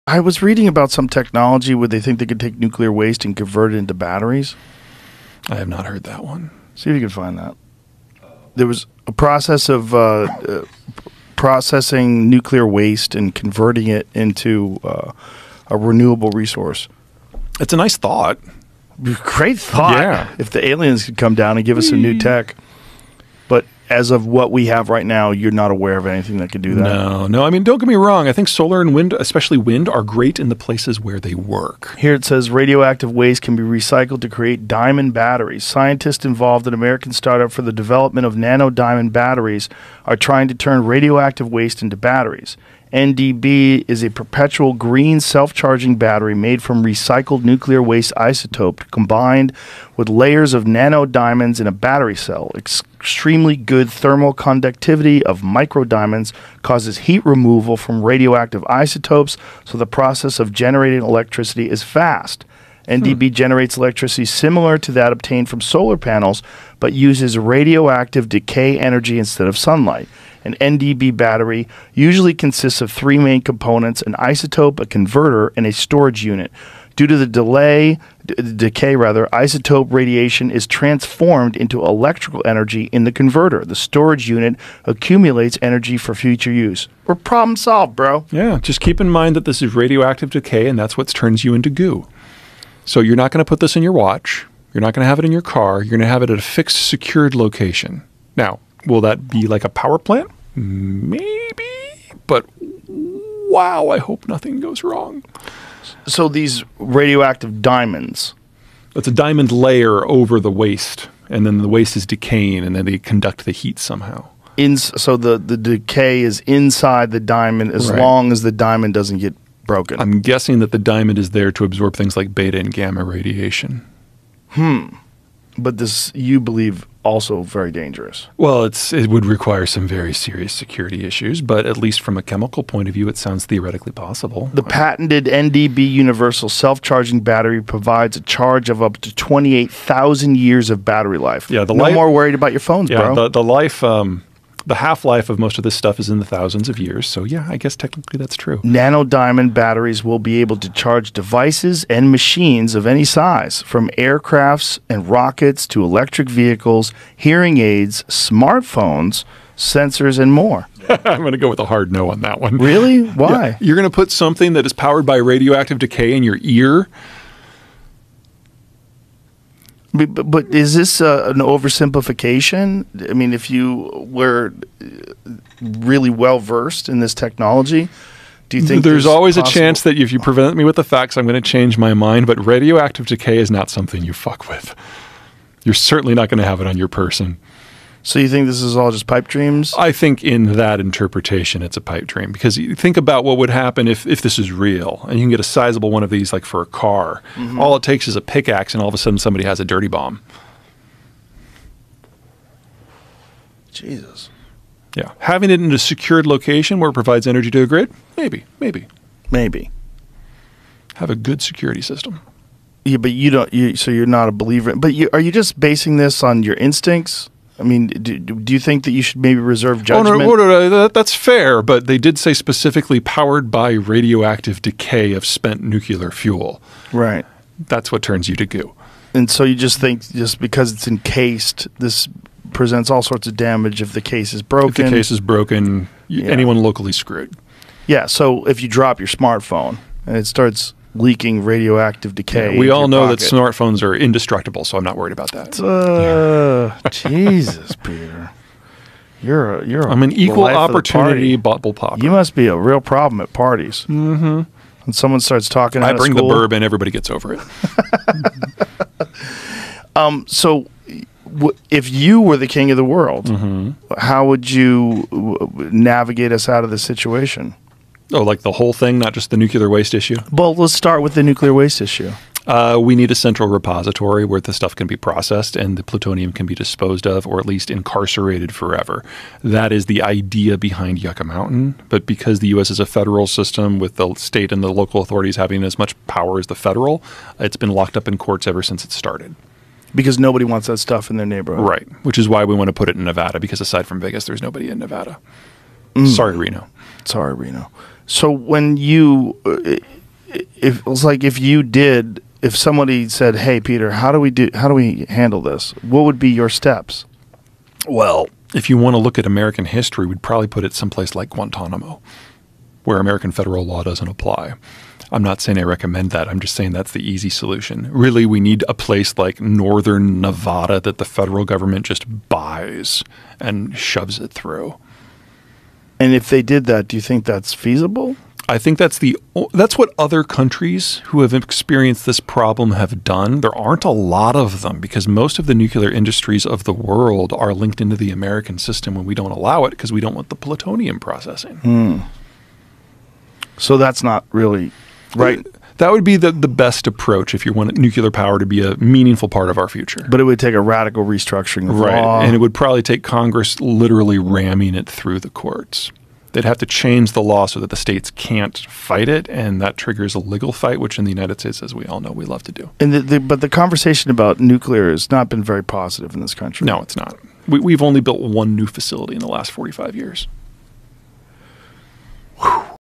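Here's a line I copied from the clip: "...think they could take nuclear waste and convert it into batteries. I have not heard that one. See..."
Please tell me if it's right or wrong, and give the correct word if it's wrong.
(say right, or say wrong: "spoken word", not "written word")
right.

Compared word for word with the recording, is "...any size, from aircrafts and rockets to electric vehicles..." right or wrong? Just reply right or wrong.
right.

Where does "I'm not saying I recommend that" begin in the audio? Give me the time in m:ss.
5:15.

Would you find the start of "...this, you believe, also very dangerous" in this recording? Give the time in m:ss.
2:05.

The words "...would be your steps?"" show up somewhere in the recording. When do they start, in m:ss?
5:06.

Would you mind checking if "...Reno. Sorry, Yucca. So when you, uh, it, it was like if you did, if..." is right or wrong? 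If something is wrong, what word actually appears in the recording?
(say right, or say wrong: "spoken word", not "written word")
wrong: "Reno", not "Yucca".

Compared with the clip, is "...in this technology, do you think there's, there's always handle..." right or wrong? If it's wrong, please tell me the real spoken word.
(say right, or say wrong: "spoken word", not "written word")
wrong: "possible", not "handle".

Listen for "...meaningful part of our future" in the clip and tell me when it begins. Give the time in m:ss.
5:48.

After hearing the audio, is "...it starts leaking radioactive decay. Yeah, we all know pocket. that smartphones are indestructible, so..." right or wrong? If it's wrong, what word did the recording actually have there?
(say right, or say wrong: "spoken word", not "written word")
right.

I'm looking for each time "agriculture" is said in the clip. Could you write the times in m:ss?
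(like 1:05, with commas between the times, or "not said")
not said.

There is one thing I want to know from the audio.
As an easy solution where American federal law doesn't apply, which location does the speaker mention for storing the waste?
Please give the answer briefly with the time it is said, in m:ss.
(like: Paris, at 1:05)
Guantanamo, at 5:11.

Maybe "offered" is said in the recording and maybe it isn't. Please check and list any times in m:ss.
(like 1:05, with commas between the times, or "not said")
not said.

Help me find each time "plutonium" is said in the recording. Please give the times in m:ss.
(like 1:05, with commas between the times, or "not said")
4:35, 5:40.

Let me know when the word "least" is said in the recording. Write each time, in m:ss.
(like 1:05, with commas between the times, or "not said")
2:11, 4:37.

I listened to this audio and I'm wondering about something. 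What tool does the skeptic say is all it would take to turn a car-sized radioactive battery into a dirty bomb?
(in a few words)
A pickaxe.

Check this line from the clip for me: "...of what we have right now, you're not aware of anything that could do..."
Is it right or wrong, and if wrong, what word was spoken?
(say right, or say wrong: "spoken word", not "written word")
right.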